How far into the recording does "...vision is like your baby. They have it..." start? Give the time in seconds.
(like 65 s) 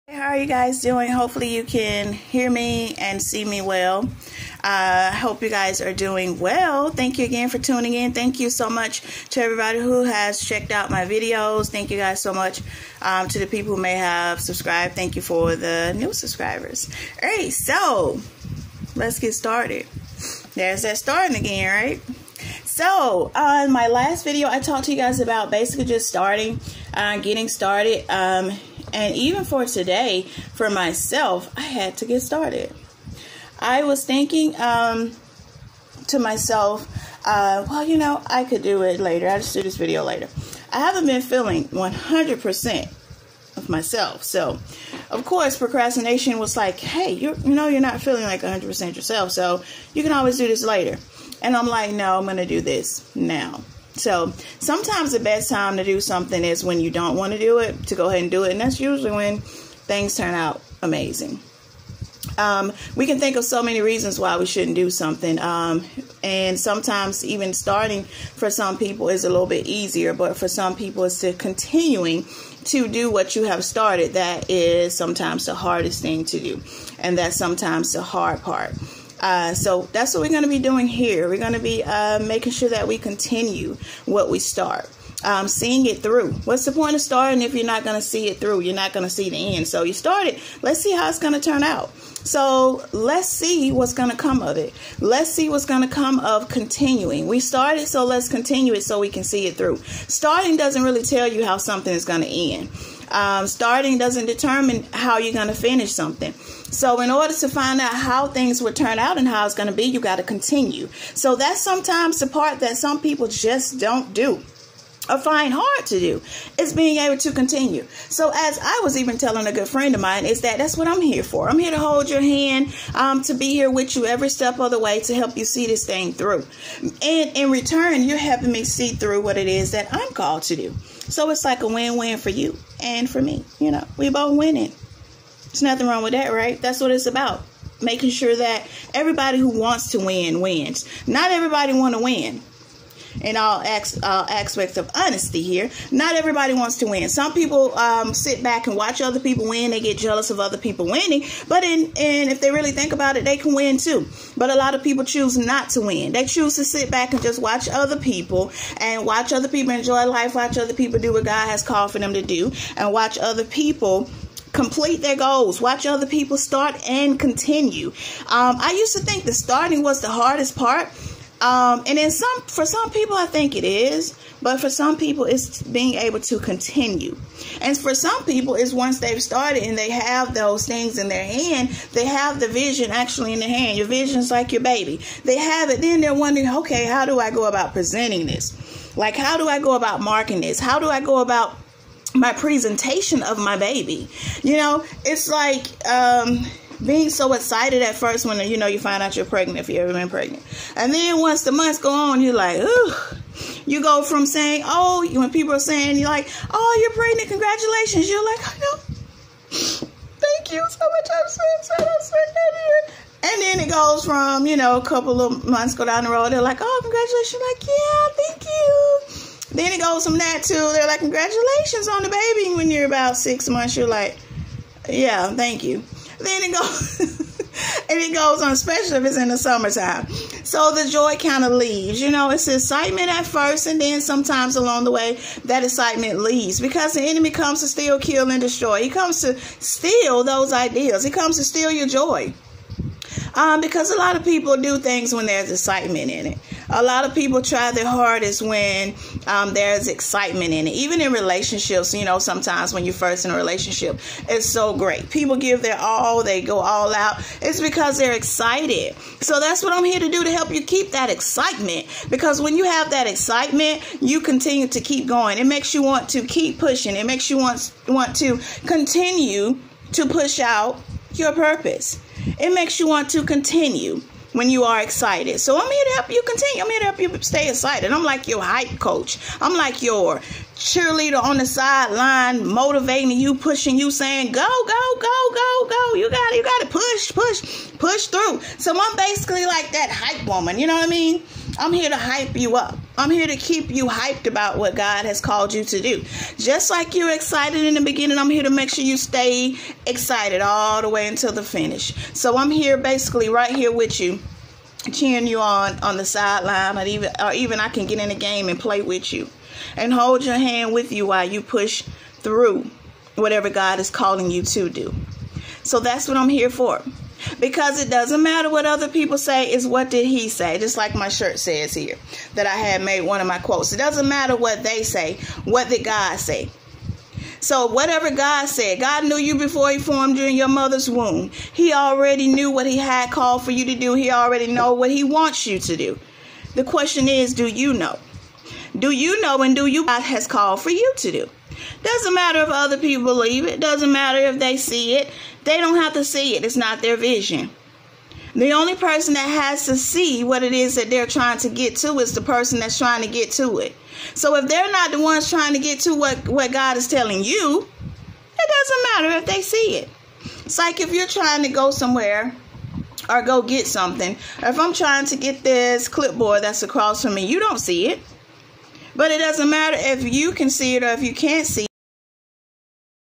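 183 s.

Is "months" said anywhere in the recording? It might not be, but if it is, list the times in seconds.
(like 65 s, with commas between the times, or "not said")
201 s, 215 s, 223 s.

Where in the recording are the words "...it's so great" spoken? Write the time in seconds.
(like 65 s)
254 s.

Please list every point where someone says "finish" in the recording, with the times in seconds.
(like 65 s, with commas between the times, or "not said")
105 s, 301 s.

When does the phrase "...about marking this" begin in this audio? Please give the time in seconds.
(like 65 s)
189 s.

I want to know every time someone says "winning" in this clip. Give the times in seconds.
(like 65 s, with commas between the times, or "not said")
134 s, 150 s.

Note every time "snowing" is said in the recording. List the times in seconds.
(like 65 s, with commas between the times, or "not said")
not said.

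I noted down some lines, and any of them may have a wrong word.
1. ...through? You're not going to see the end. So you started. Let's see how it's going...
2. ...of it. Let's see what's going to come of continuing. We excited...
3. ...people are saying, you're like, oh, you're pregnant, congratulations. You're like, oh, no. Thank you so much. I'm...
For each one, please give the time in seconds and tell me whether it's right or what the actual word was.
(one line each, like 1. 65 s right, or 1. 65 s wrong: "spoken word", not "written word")
1. 88 s right
2. 94 s wrong: "started", not "excited"
3. 205 s right.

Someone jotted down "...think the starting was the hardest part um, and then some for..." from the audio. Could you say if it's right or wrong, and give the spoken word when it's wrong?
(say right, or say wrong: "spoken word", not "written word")
right.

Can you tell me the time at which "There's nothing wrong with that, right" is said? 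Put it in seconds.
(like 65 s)
135 s.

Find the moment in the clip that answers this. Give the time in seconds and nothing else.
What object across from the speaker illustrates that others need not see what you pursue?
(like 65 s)
365 s.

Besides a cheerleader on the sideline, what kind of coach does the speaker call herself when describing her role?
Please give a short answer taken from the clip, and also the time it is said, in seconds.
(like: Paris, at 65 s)
hype coach, at 278 s.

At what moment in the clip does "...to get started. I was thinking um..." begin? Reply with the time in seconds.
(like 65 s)
31 s.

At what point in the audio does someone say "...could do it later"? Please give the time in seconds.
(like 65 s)
38 s.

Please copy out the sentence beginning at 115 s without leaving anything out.
A fine hard to do is being able to continue.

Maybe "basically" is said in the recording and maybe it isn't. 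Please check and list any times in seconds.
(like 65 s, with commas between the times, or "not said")
25 s, 288 s, 302 s.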